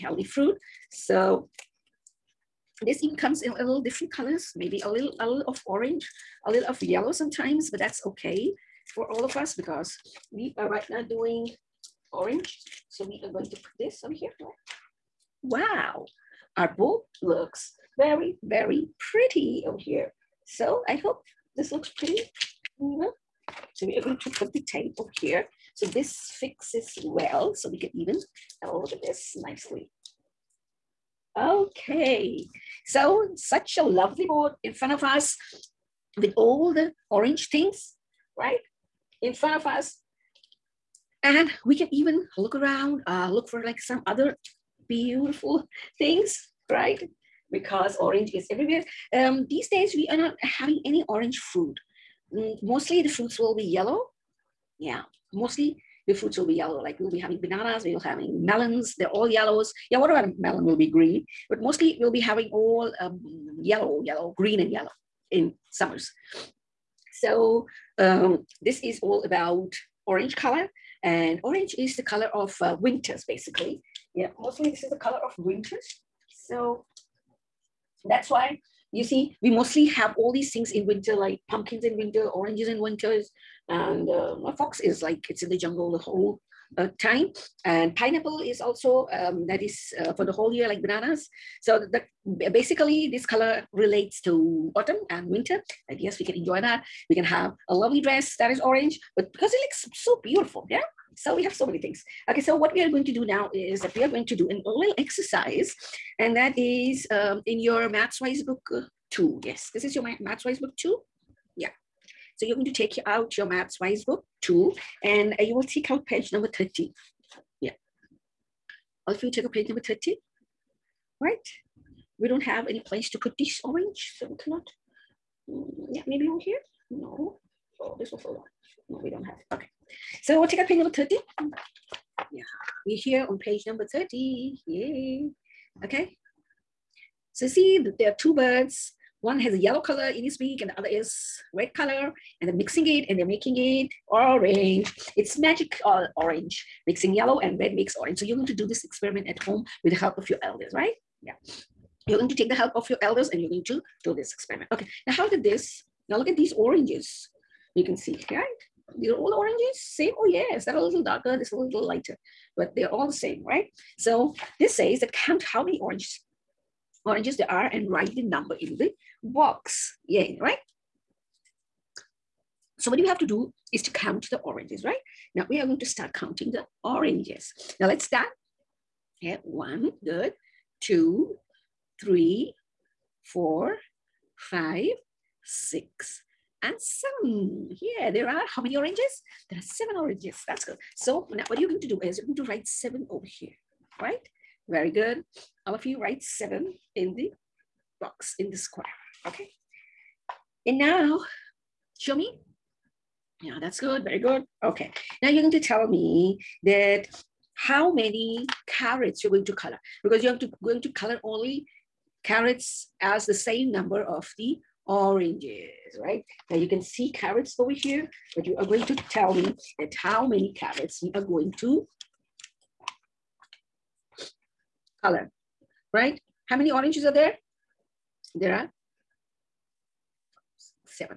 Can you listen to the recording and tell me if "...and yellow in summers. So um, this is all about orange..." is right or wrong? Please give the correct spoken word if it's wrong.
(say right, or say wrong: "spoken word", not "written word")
right.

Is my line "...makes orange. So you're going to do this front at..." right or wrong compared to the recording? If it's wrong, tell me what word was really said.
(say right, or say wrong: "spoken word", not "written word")
wrong: "experiment", not "front".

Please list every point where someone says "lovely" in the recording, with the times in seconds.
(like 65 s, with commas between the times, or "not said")
33 s, 97 s.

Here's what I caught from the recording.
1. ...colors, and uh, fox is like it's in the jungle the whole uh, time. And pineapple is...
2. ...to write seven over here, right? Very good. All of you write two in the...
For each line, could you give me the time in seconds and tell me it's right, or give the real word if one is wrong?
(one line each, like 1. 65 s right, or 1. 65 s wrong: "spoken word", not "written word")
1. 82 s wrong: "winters", not "colors"
2. 192 s wrong: "seven", not "two".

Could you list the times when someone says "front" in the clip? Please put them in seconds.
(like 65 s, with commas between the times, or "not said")
34 s, 39 s.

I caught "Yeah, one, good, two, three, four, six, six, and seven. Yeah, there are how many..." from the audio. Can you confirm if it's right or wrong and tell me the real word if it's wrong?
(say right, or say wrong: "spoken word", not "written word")
wrong: "five", not "six".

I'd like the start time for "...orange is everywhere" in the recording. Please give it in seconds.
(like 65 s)
47 s.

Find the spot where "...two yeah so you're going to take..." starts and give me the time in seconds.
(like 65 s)
110 s.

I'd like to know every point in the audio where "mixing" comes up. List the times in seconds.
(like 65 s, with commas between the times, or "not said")
142 s, 146 s.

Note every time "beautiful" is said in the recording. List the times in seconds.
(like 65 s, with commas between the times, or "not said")
44 s, 100 s.